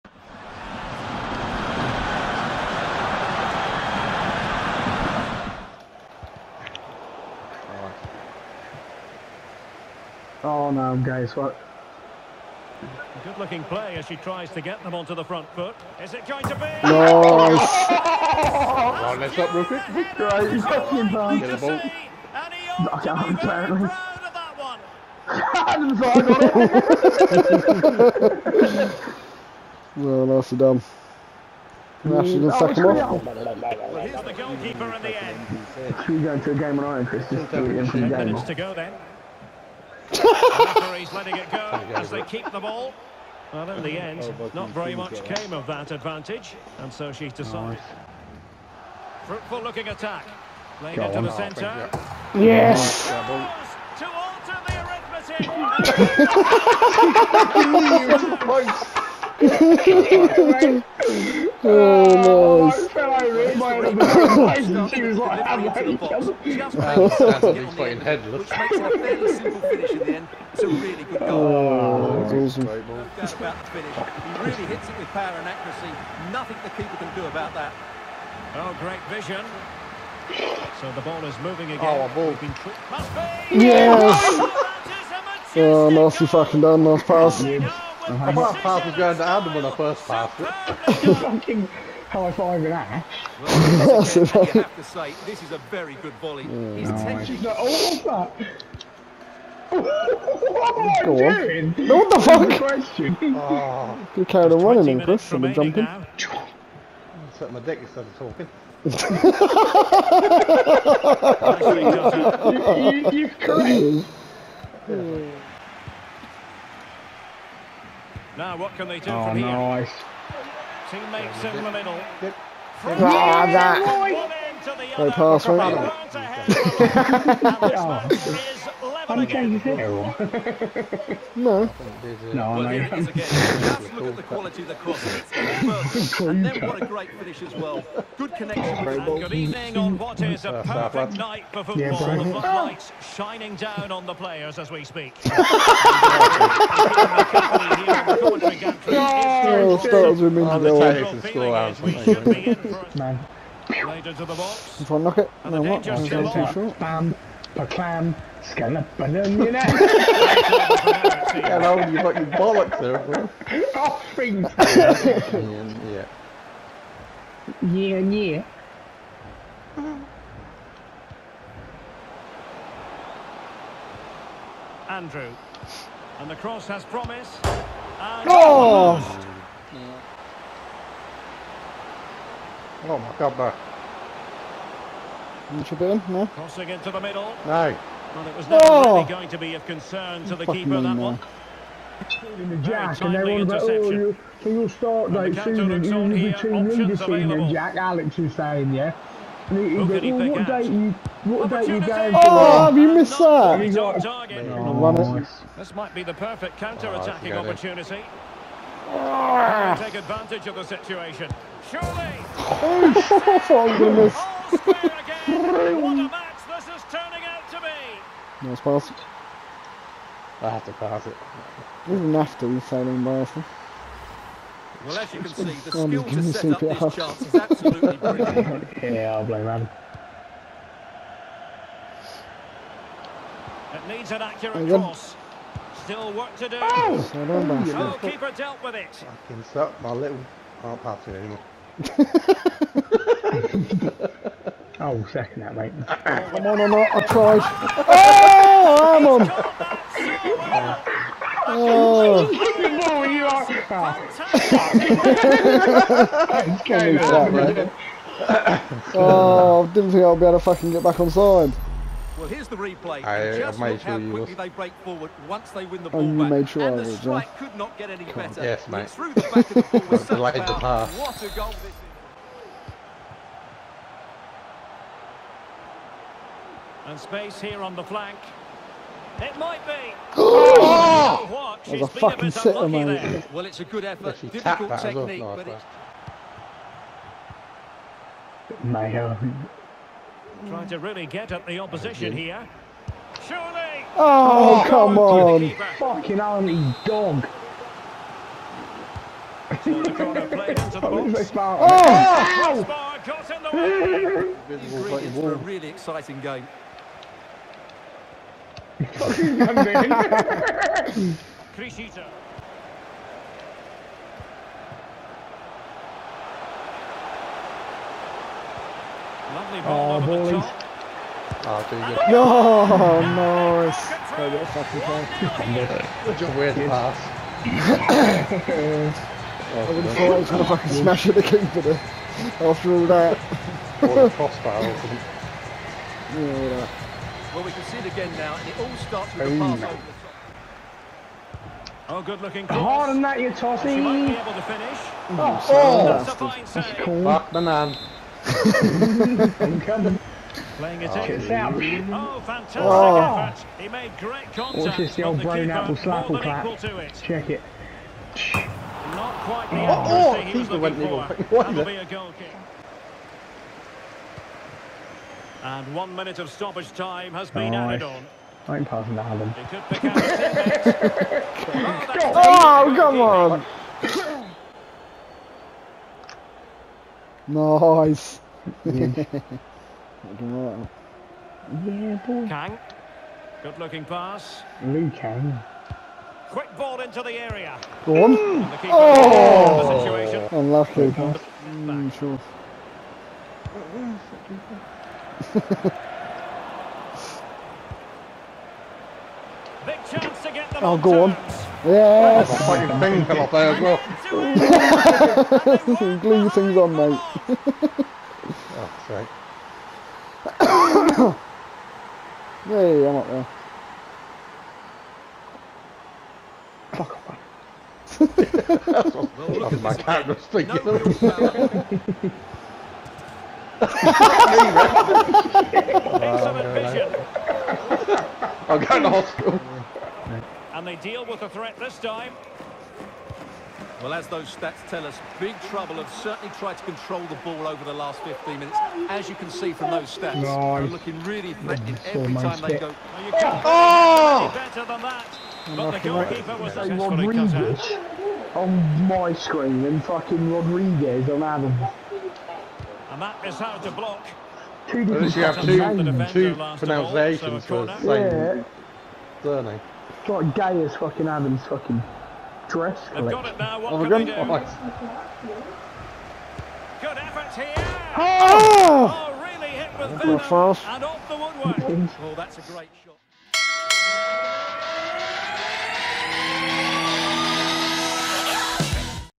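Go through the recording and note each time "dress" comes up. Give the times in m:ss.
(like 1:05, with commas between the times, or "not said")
7:42.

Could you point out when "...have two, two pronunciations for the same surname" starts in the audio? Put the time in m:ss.
7:35.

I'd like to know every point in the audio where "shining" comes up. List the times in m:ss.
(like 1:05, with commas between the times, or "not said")
2:23.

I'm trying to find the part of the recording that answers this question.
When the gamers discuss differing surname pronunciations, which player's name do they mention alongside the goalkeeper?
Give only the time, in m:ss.
7:30.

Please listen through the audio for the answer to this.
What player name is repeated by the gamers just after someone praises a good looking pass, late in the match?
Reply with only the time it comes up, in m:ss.
6:24.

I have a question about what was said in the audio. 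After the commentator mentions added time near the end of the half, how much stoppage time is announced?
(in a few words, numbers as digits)
1 minute.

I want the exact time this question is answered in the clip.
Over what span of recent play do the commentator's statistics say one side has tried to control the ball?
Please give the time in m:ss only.
7:18.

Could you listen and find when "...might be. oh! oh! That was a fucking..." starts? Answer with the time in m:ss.
4:39.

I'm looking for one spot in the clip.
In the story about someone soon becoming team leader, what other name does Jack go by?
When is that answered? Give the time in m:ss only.
3:17.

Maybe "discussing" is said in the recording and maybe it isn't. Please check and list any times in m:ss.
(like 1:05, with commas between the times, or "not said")
not said.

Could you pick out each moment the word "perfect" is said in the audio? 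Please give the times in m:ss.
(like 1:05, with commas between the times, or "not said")
2:20, 3:26.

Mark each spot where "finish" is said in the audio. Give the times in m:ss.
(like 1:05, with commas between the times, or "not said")
1:13, 2:17, 5:44.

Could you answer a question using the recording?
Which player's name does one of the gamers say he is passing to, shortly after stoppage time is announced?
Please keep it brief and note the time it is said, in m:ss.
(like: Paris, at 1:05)
Alan, at 6:09.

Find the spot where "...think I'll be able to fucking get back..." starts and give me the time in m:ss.
4:20.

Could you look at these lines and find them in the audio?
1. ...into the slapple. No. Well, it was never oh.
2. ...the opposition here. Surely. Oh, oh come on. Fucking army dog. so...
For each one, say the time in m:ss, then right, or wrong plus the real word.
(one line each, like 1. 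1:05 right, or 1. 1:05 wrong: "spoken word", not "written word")
1. 3:06 wrong: "middle", not "slapple"
2. 4:51 right.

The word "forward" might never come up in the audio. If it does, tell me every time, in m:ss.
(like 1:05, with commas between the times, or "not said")
4:24.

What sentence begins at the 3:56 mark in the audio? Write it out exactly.
Oh, so oh, oh keeper dealt with it.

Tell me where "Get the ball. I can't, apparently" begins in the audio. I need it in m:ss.
0:21.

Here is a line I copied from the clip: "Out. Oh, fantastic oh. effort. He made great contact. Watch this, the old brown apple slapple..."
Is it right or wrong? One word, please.
right.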